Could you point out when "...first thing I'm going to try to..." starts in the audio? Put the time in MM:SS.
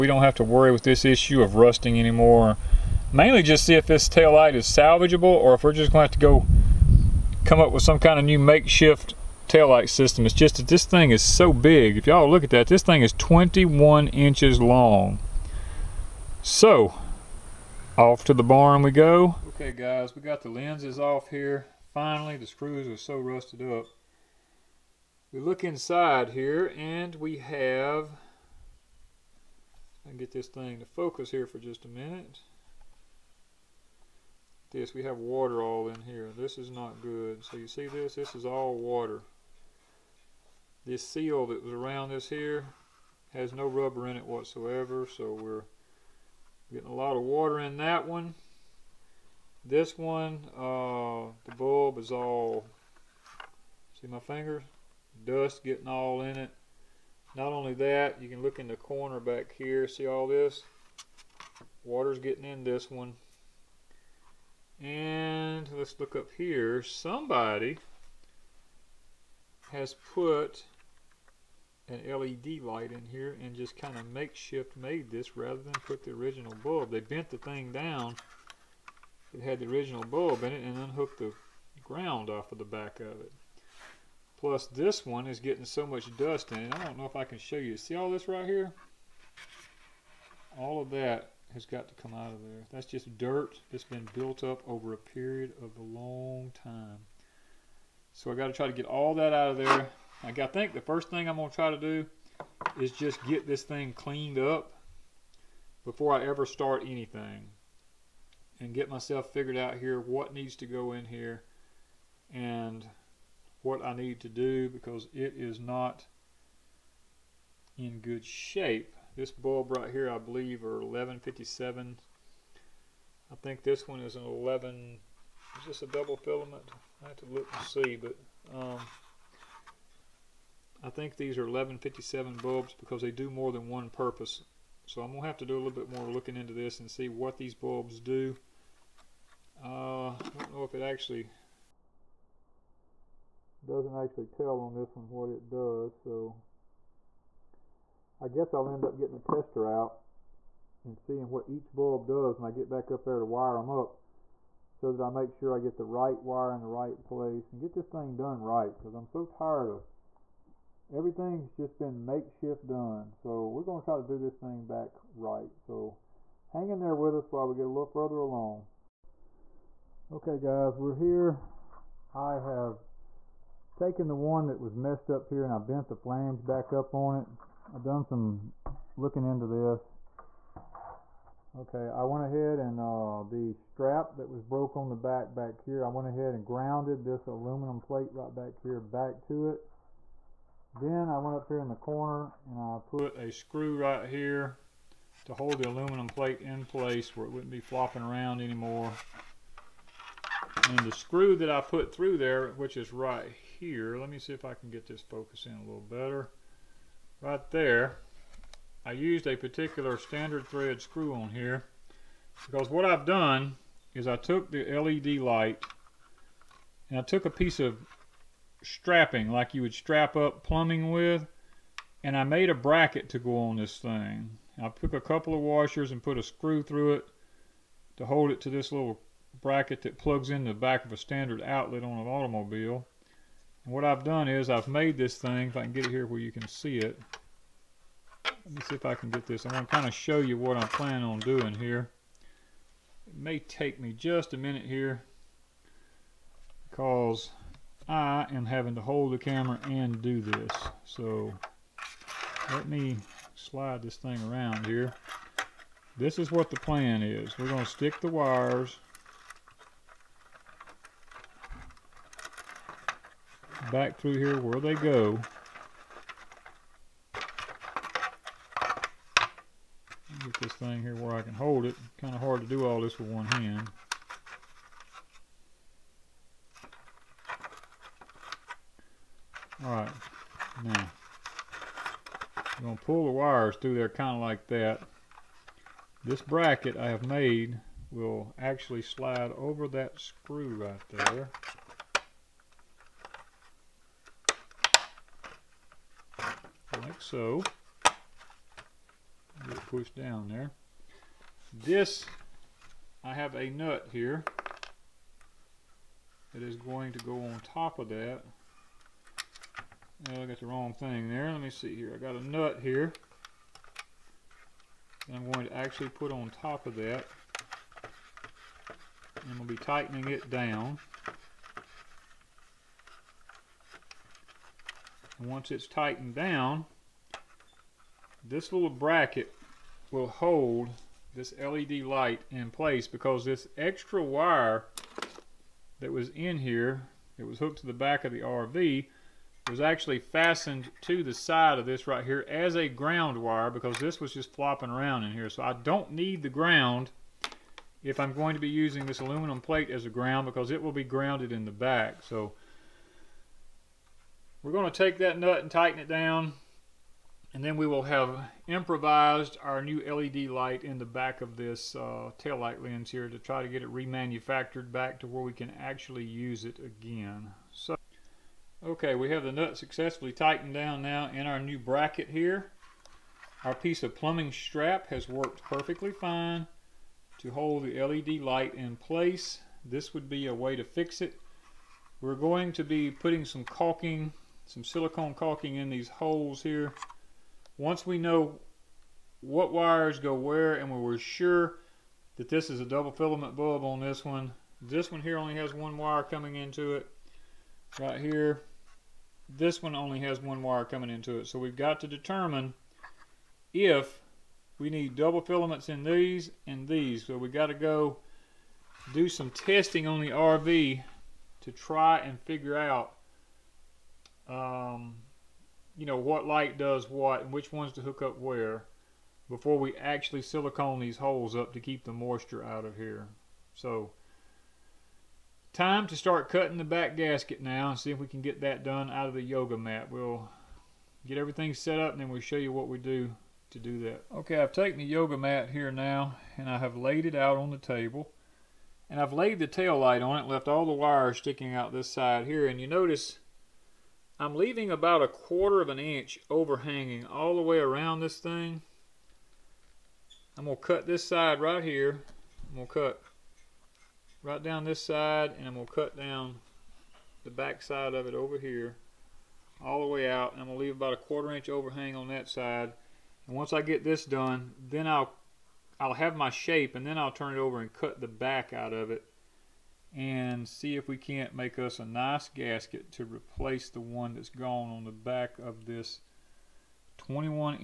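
01:40.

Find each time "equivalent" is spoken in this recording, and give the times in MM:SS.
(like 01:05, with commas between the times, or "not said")
not said.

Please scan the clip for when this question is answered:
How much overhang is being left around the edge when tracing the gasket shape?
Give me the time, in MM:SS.
07:25.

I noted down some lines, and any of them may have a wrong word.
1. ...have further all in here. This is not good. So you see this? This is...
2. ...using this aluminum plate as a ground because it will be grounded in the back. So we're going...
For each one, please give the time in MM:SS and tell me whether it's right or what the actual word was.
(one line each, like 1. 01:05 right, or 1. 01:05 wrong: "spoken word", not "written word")
1. 00:35 wrong: "water", not "further"
2. 05:48 right.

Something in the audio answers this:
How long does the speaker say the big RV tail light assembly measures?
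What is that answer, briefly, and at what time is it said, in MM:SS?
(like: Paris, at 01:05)
21 inches, at 00:13.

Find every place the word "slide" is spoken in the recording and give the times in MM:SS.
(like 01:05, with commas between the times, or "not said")
04:13, 04:48.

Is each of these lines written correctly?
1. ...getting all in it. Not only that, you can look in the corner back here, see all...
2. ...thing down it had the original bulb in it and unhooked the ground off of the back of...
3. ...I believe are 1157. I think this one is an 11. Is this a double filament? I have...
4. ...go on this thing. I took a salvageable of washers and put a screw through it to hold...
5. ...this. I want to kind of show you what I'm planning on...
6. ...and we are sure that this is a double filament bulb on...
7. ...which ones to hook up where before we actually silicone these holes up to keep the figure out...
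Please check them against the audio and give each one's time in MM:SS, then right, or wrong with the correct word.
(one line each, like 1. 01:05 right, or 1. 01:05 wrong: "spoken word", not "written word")
1. 00:55 right
2. 01:17 right
3. 02:00 right
4. 03:43 wrong: "couple", not "salvageable"
5. 03:59 right
6. 06:30 right
7. 06:57 wrong: "moisture", not "figure".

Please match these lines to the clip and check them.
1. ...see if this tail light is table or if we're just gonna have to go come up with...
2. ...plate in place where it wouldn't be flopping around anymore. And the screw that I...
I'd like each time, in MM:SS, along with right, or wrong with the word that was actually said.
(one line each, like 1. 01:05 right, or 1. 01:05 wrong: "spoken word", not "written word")
1. 00:03 wrong: "salvageable", not "table"
2. 03:16 right.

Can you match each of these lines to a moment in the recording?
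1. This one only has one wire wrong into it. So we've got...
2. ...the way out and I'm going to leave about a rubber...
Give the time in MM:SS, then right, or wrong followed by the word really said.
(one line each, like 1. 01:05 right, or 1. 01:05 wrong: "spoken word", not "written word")
1. 06:39 wrong: "coming", not "wrong"
2. 07:39 wrong: "quarter", not "rubber".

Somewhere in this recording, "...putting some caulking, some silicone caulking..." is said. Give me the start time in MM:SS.
06:22.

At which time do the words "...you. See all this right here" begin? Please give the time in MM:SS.
01:27.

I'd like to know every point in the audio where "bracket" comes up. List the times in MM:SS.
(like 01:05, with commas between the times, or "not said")
03:42, 03:49, 04:46, 05:28, 06:11.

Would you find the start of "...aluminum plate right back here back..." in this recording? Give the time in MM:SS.
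03:07.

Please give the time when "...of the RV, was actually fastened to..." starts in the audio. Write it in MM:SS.
05:38.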